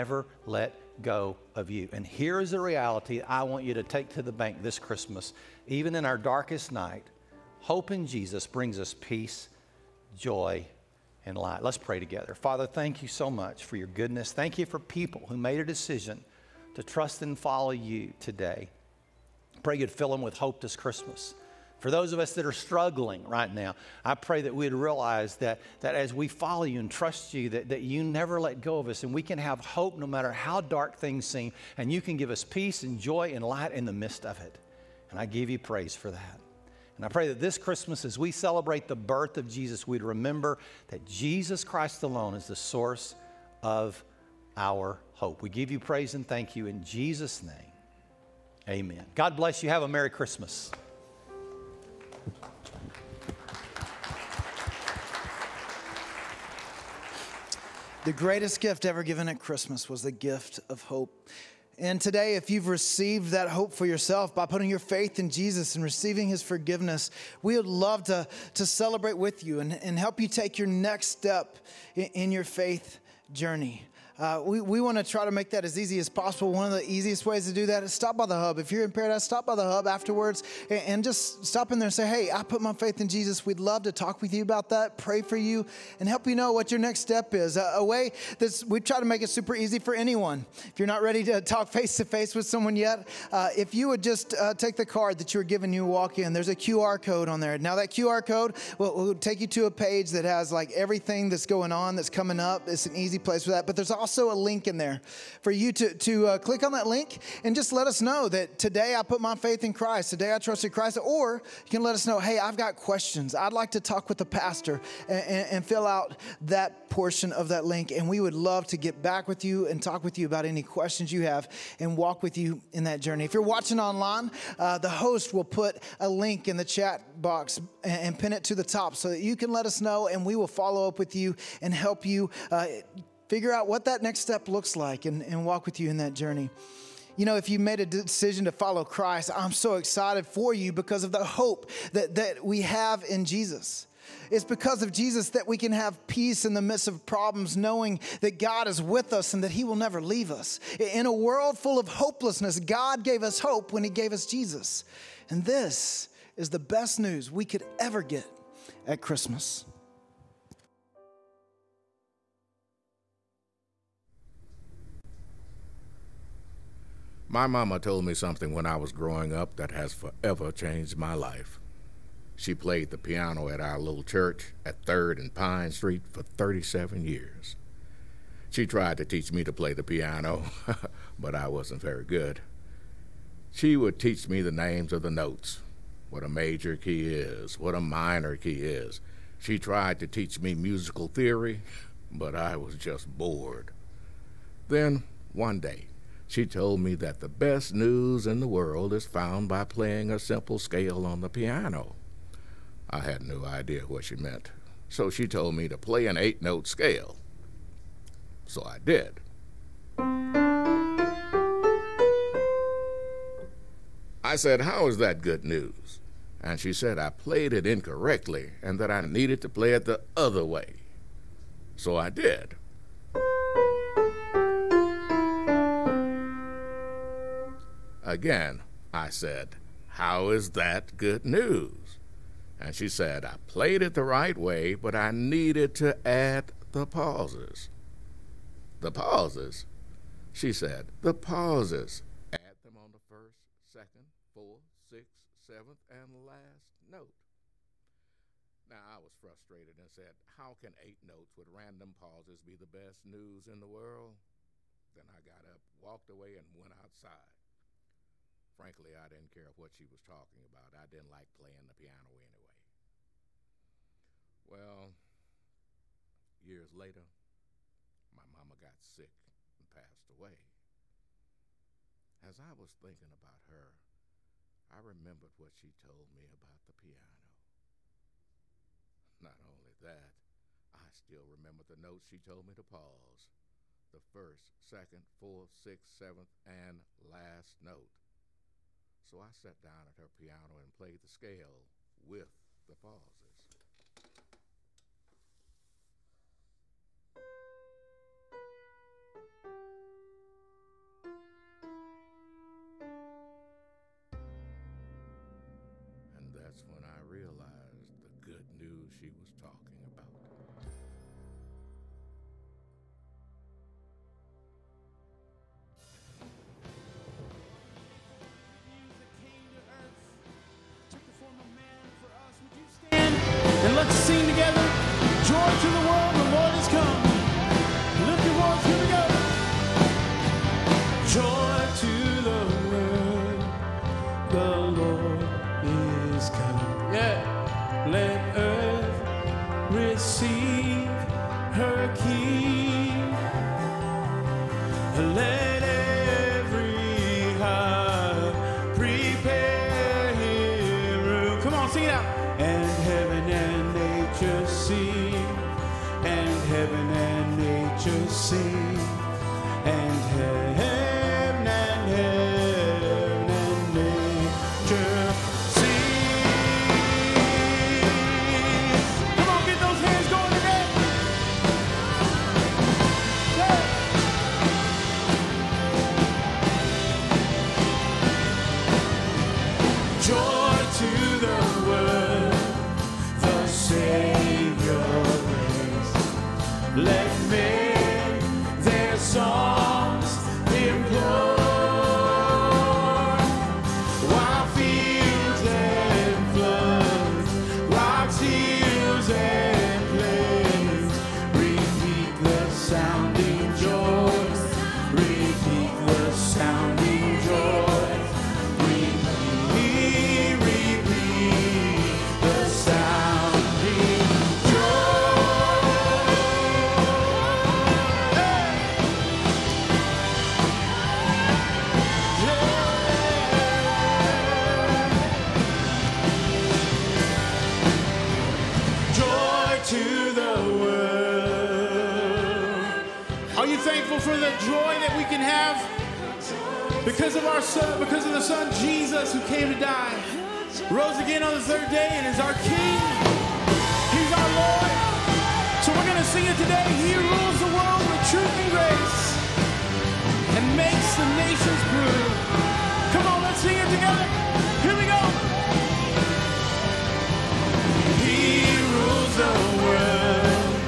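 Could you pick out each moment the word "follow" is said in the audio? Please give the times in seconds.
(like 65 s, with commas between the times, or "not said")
17 s, 26 s, 130 s, 138 s.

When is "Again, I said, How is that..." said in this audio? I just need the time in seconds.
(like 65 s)
228 s.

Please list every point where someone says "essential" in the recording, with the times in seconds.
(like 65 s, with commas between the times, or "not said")
not said.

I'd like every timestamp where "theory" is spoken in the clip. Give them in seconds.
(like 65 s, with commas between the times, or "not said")
191 s.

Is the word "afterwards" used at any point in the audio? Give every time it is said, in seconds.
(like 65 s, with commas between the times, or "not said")
79 s.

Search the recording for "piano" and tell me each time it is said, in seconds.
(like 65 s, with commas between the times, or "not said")
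172 s, 179 s, 201 s, 261 s, 276 s, 290 s.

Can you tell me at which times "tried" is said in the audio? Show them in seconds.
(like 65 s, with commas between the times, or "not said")
178 s, 189 s.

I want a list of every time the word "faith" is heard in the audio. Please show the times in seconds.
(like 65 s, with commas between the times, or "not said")
64 s, 72 s, 82 s, 109 s.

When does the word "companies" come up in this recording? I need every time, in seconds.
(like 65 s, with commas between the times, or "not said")
not said.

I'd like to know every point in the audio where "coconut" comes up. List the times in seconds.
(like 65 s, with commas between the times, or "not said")
not said.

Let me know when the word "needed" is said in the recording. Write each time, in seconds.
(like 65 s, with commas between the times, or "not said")
219 s, 235 s.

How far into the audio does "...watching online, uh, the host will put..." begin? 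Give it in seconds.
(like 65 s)
123 s.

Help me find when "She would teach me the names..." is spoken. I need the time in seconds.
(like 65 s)
183 s.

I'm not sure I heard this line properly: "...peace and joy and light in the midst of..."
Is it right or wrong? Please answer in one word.
right.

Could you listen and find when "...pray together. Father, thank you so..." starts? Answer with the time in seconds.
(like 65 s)
11 s.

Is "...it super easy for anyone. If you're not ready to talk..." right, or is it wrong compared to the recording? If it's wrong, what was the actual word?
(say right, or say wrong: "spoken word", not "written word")
right.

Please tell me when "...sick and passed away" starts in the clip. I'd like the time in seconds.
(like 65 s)
268 s.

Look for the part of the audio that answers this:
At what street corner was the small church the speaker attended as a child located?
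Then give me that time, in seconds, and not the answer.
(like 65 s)
174 s.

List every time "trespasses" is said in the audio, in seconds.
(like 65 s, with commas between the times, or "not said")
not said.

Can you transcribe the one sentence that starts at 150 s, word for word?
In a world full of hopelessness, God gave us hope when He gave us Jesus.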